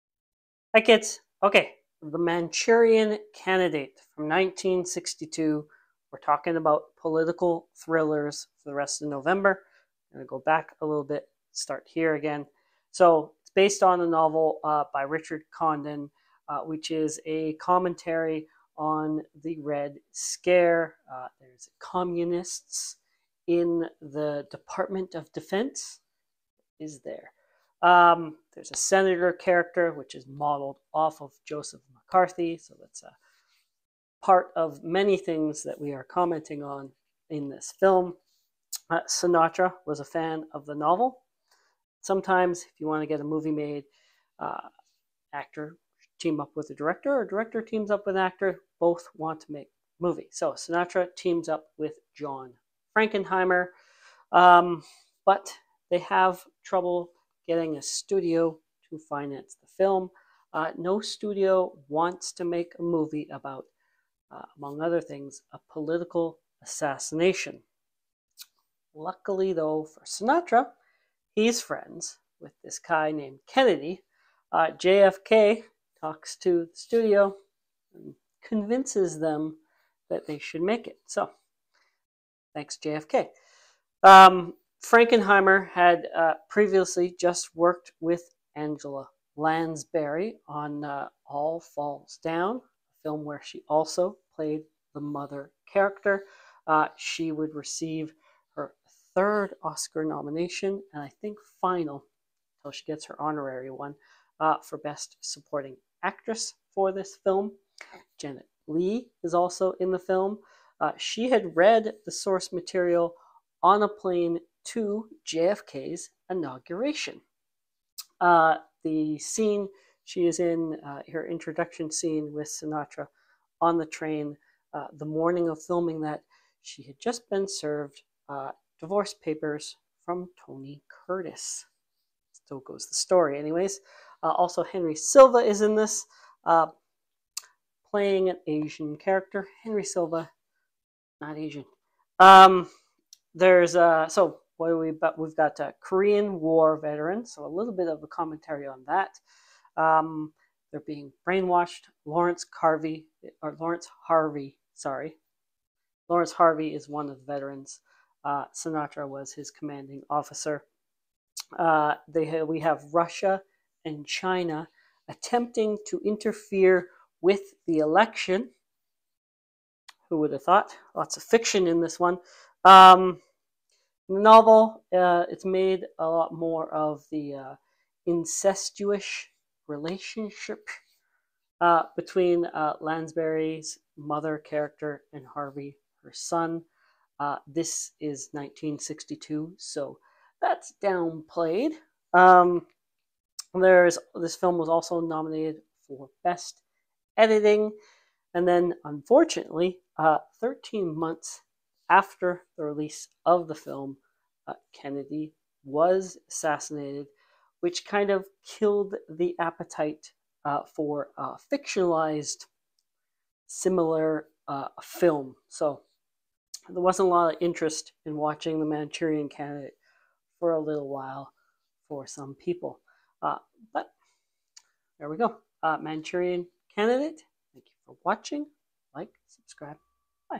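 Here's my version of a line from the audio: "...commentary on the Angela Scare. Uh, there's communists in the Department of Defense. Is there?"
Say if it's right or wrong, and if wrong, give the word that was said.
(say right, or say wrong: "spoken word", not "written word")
wrong: "Red", not "Angela".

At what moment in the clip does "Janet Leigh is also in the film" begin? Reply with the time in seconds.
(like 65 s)
108 s.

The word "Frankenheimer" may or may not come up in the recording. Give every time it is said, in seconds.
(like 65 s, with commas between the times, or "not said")
52 s, 84 s.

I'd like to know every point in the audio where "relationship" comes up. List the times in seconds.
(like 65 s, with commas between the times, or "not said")
179 s.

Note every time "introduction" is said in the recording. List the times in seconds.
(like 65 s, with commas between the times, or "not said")
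121 s.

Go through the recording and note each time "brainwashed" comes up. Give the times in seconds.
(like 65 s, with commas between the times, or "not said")
151 s.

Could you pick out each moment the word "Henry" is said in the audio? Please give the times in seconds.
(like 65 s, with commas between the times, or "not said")
134 s, 139 s.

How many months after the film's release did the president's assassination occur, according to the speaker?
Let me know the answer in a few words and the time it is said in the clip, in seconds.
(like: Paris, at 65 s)
13, at 200 s.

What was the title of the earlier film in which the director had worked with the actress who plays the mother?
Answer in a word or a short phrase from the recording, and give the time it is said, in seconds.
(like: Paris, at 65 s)
All Falls Down, at 91 s.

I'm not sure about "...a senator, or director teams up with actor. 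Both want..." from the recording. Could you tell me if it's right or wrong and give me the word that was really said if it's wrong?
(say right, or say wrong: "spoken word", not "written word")
wrong: "director", not "senator".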